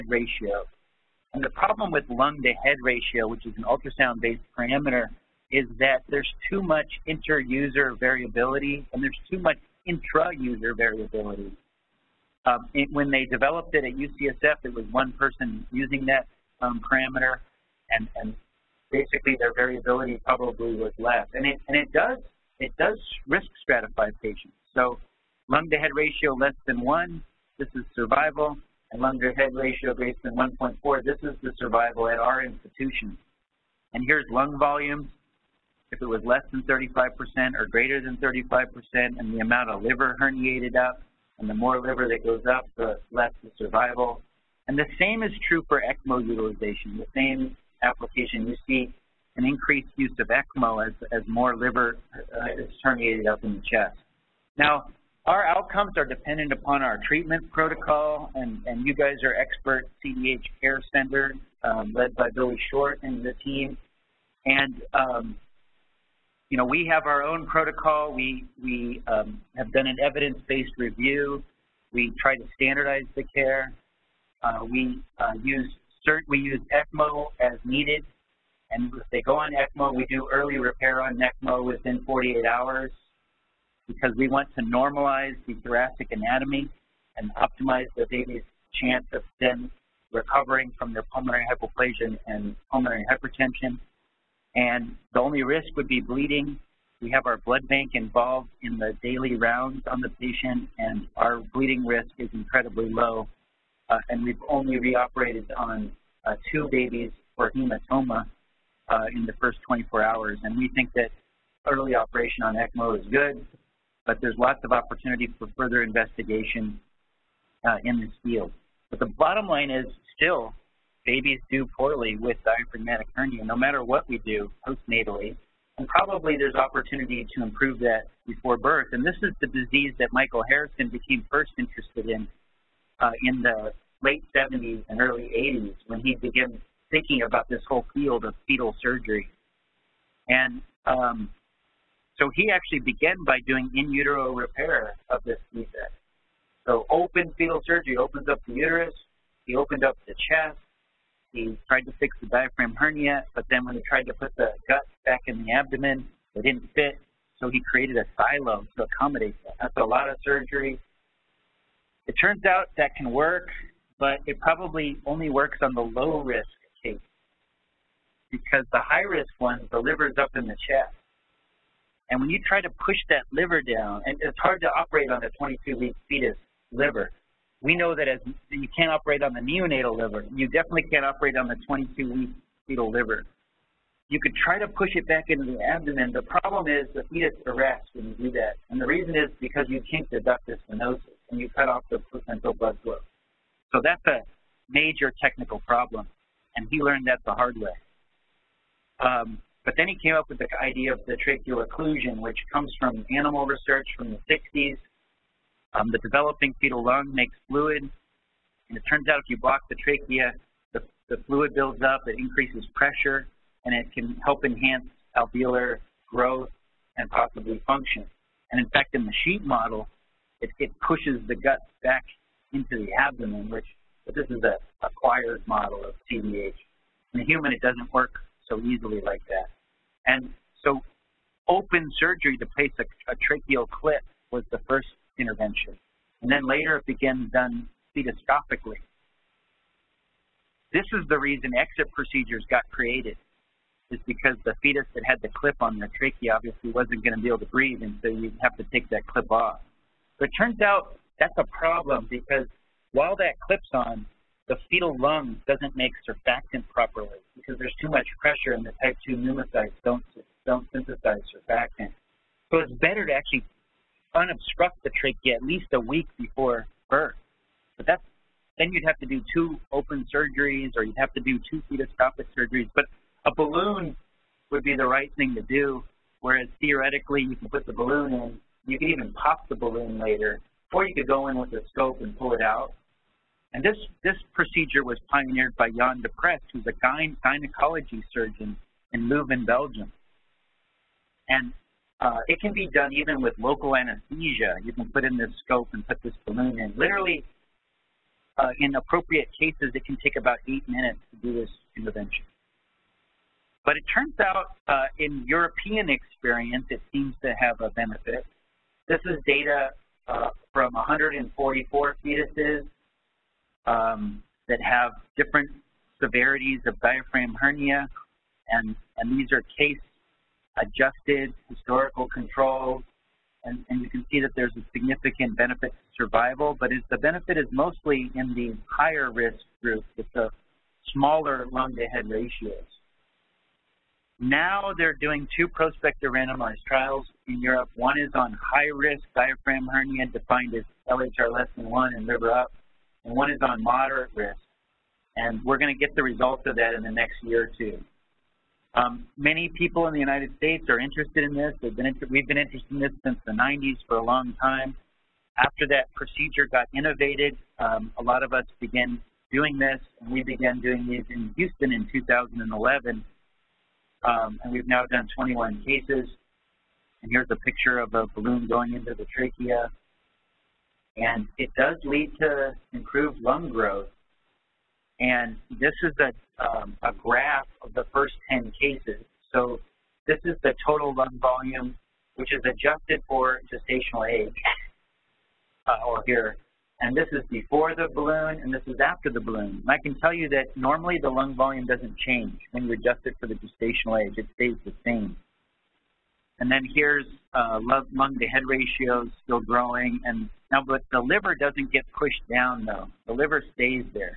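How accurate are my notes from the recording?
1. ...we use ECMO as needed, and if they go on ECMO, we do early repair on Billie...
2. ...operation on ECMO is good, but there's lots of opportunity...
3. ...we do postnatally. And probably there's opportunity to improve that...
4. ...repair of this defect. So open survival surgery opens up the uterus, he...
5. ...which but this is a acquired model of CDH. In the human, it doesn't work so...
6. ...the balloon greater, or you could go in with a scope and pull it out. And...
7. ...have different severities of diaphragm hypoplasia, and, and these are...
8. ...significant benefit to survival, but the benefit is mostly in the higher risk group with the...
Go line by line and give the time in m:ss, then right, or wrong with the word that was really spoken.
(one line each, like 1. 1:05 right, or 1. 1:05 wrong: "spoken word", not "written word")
1. 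1:16 wrong: "ECMO", not "Billie"
2. 1:51 right
3. 2:04 right
4. 2:24 wrong: "fetal", not "survival"
5. 3:43 right
6. 4:39 wrong: "later", not "greater"
7. 5:14 wrong: "hernia", not "hypoplasia"
8. 5:24 right.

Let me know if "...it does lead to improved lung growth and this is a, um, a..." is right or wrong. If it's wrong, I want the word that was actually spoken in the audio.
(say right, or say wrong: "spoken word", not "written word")
right.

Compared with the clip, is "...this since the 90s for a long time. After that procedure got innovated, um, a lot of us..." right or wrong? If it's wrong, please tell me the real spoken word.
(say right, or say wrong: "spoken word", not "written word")
right.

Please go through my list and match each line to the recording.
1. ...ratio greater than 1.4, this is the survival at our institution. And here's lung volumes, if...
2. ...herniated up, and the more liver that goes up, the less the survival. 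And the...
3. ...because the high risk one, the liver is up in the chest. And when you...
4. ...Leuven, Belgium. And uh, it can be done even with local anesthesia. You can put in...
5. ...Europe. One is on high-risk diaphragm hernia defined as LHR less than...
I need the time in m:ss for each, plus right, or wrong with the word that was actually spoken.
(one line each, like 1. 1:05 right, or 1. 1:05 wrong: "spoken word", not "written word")
1. 0:29 right
2. 0:40 right
3. 2:48 right
4. 4:49 right
5. 5:37 right.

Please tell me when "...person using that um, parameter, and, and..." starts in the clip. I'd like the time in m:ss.
0:15.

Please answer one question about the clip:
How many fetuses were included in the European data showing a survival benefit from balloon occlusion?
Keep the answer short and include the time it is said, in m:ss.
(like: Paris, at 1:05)
144, at 5:10.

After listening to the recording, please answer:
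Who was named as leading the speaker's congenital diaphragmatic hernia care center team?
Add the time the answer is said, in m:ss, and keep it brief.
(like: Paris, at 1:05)
Billie Short, at 1:02.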